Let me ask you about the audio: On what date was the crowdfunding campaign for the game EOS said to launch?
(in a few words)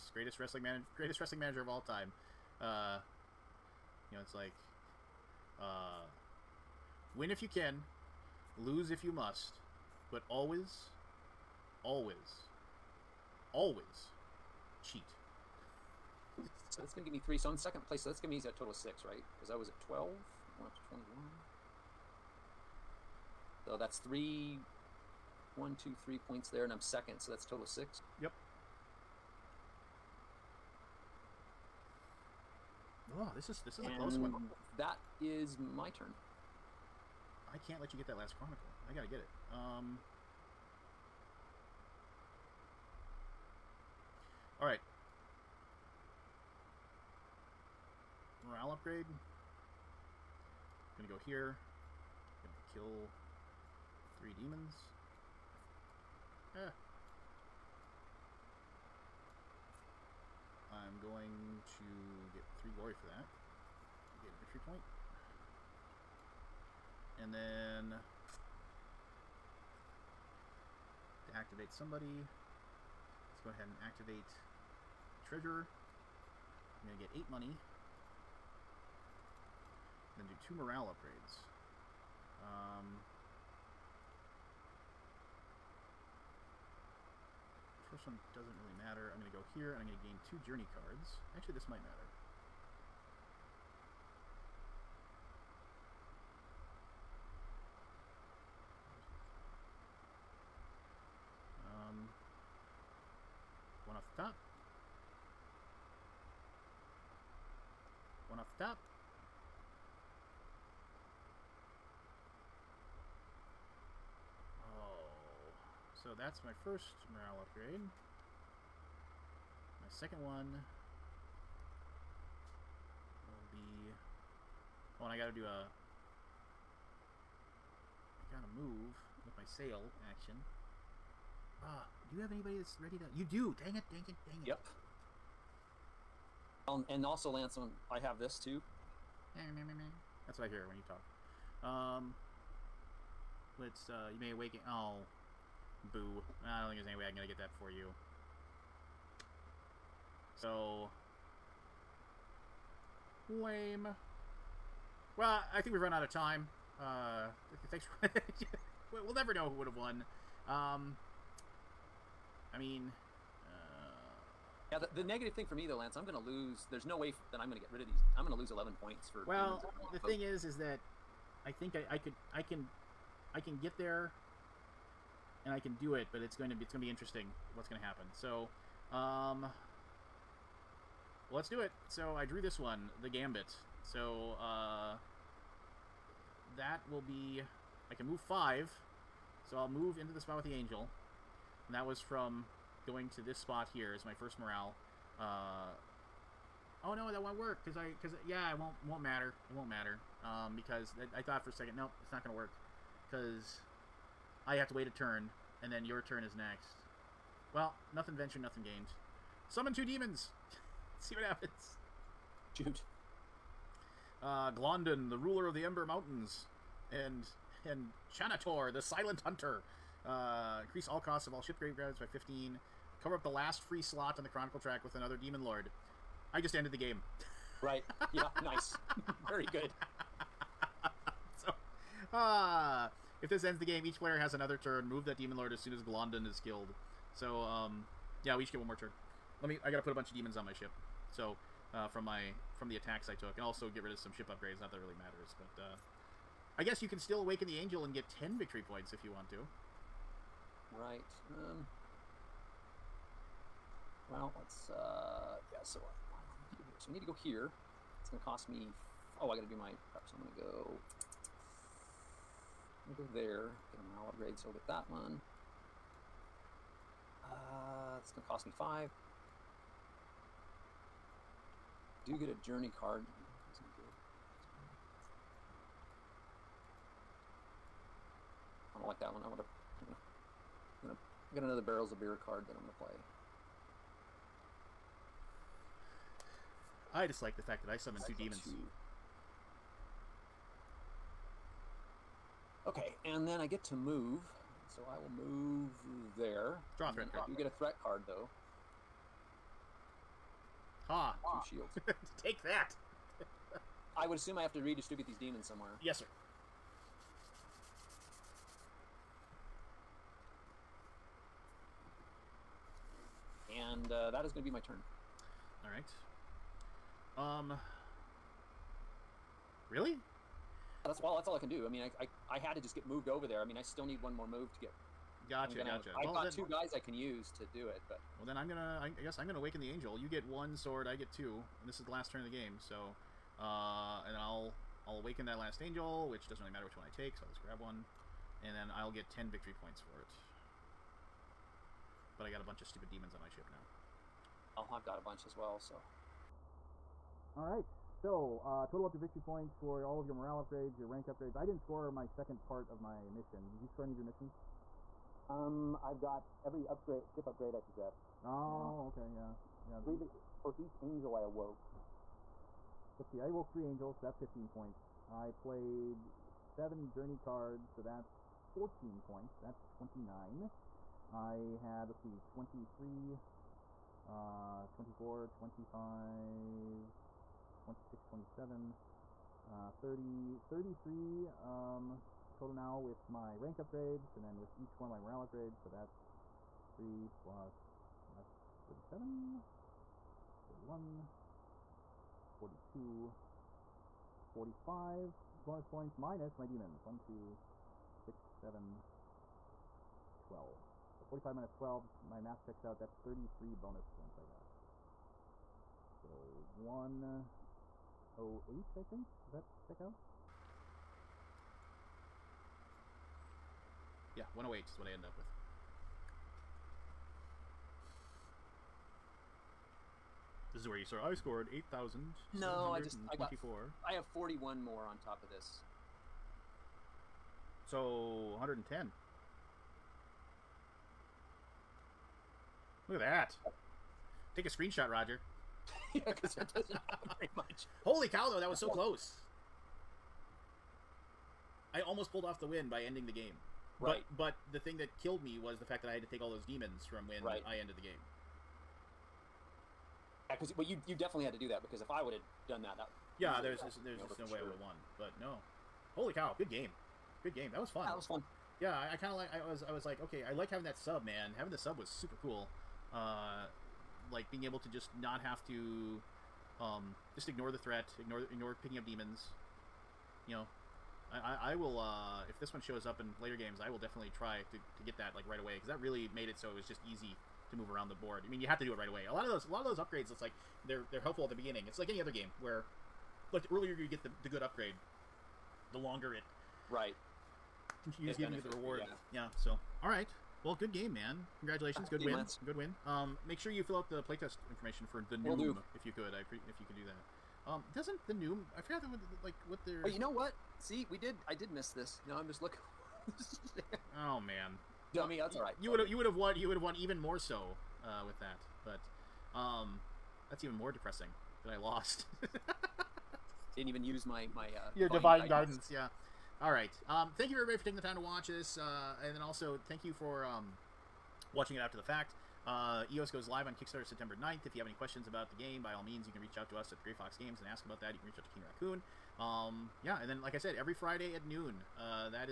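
September 9th.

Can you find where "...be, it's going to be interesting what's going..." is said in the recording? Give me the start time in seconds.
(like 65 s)
176 s.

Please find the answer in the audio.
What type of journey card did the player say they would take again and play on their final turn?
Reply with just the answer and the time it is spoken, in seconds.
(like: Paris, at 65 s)
Barrels of beer, at 281 s.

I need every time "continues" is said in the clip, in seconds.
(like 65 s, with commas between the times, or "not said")
487 s.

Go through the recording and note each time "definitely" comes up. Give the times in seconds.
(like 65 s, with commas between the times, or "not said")
450 s, 473 s.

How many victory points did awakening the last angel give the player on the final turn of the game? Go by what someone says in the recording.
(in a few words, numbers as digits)
10.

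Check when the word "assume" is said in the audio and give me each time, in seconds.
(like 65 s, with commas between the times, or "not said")
304 s.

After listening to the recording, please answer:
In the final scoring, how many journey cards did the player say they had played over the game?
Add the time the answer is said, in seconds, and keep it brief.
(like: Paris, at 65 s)
7, at 366 s.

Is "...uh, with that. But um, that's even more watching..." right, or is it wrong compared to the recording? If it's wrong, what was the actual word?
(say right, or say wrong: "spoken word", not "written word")
wrong: "depressing", not "watching".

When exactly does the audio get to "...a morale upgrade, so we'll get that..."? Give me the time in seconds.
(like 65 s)
263 s.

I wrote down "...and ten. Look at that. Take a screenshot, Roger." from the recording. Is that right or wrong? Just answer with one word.
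right.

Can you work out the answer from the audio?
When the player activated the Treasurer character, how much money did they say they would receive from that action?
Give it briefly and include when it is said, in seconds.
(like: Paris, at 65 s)
8, at 77 s.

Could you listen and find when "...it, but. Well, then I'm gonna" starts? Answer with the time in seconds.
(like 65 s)
327 s.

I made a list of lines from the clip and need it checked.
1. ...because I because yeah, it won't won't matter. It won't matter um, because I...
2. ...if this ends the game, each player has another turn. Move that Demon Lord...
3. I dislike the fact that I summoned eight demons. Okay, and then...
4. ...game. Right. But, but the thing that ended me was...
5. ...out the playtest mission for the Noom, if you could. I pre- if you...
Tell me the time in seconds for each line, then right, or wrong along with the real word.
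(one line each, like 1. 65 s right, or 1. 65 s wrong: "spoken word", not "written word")
1. 197 s right
2. 233 s right
3. 286 s wrong: "two", not "eight"
4. 443 s wrong: "killed", not "ended"
5. 493 s wrong: "information", not "mission".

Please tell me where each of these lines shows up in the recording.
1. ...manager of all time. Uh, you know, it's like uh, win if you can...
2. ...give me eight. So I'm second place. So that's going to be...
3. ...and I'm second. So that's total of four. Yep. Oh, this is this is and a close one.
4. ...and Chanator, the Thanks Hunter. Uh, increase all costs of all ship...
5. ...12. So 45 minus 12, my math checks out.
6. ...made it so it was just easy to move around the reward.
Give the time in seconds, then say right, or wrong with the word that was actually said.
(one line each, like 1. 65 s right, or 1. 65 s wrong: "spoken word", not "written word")
1. 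1 s right
2. 17 s wrong: "three", not "eight"
3. 26 s wrong: "six", not "four"
4. 217 s wrong: "Silent", not "Thanks"
5. 400 s right
6. 476 s wrong: "board", not "reward".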